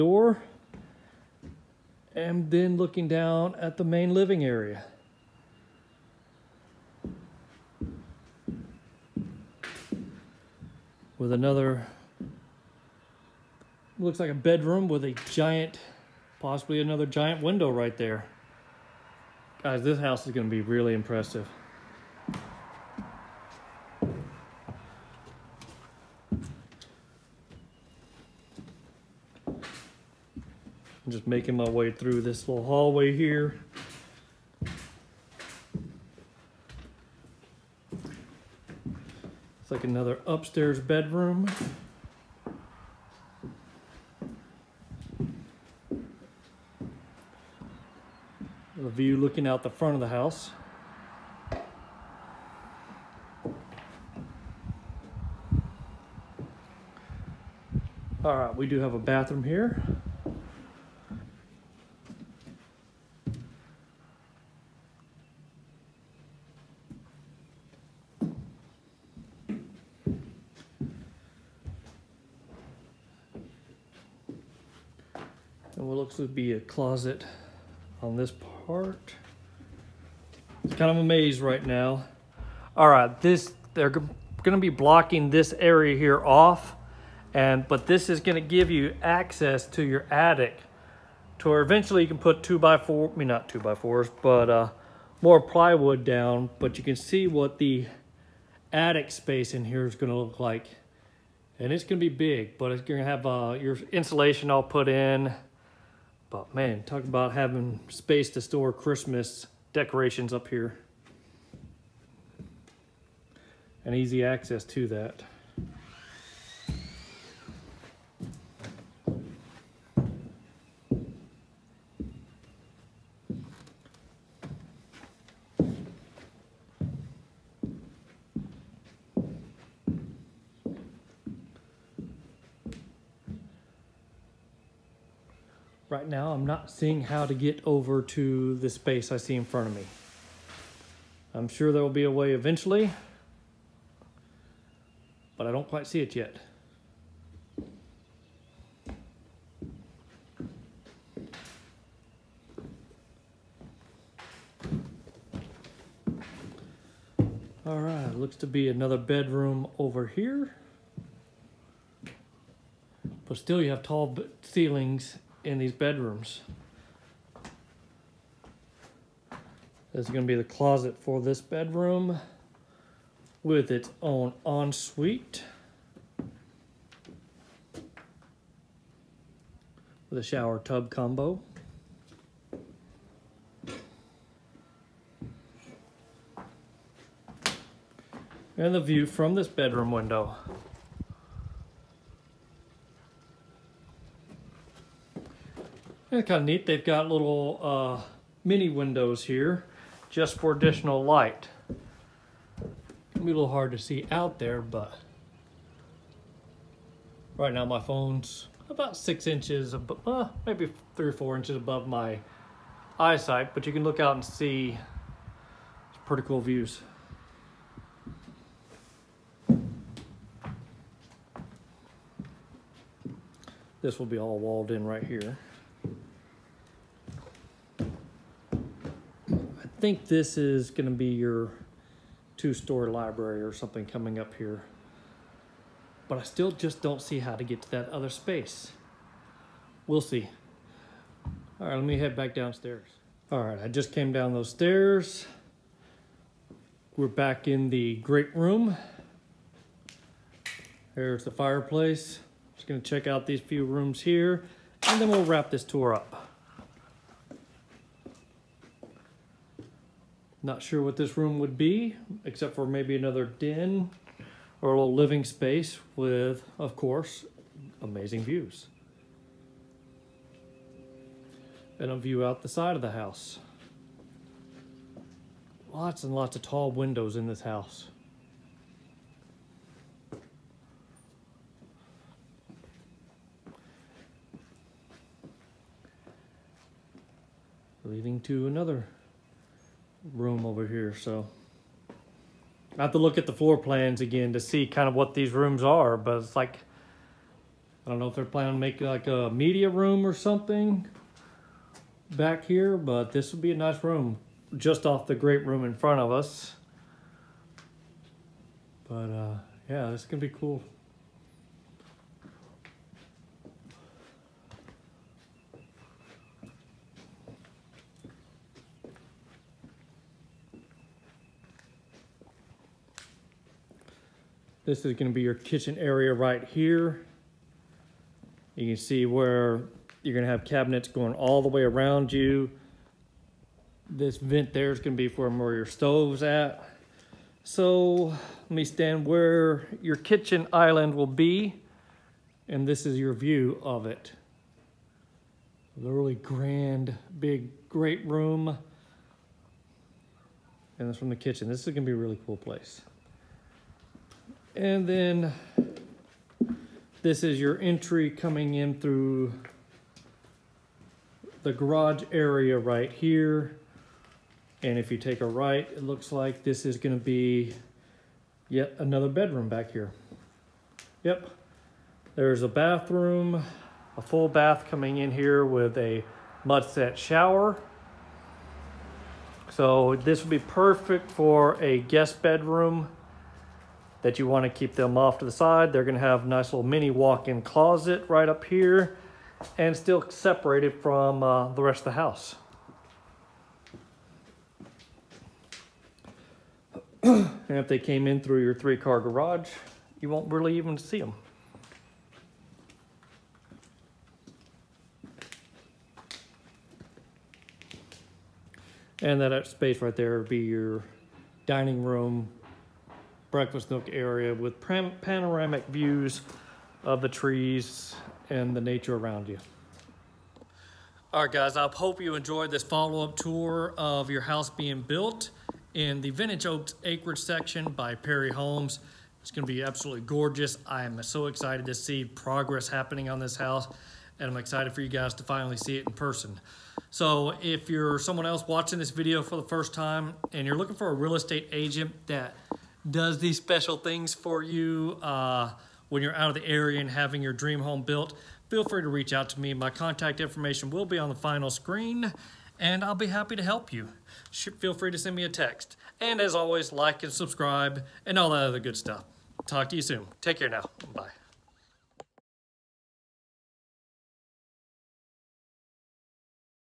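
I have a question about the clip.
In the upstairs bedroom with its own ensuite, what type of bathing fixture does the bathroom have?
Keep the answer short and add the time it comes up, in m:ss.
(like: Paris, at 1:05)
Shower tub combo, at 3:00.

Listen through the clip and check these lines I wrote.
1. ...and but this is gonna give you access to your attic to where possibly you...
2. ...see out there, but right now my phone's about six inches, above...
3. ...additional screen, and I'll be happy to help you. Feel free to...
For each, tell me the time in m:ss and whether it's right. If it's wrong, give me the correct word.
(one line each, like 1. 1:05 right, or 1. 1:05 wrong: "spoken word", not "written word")
1. 1:27 wrong: "eventually", not "possibly"
2. 3:23 right
3. 7:31 wrong: "final", not "additional".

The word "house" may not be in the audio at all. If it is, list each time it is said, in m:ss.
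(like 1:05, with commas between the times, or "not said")
0:19, 0:50, 4:32, 4:37, 6:31, 7:04, 7:13.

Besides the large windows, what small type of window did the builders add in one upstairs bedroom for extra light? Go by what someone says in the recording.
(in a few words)
Mini windows.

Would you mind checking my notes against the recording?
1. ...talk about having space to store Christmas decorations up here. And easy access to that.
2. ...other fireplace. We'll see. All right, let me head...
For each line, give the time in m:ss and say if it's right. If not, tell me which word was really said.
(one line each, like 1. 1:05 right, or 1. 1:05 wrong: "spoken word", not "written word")
1. 1:46 right
2. 3:57 wrong: "space", not "fireplace".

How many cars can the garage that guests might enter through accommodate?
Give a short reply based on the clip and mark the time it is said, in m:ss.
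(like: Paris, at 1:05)
3, at 6:38.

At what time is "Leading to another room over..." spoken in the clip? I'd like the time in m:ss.
4:47.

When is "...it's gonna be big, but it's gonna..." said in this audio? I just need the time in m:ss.
1:41.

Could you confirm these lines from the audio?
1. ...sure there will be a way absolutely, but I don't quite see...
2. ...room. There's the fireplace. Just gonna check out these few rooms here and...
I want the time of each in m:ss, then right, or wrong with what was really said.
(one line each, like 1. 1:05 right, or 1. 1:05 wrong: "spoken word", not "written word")
1. 2:21 wrong: "eventually", not "absolutely"
2. 4:08 right.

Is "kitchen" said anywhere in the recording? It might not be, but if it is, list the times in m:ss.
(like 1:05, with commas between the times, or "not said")
5:25, 5:39, 5:51.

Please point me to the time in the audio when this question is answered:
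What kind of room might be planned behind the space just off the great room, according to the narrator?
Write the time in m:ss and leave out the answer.
4:59.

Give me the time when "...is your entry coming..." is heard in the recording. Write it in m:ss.
5:57.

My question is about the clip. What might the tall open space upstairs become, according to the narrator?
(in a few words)
Two-story library.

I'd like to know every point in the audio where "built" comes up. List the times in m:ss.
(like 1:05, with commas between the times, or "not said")
7:04, 7:27.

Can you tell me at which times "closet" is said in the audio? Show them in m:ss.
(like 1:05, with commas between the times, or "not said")
1:16, 2:50, 6:27.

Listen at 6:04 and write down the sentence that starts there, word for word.
And if you take a right, it looks like this is gonna be yet another bedroom back here.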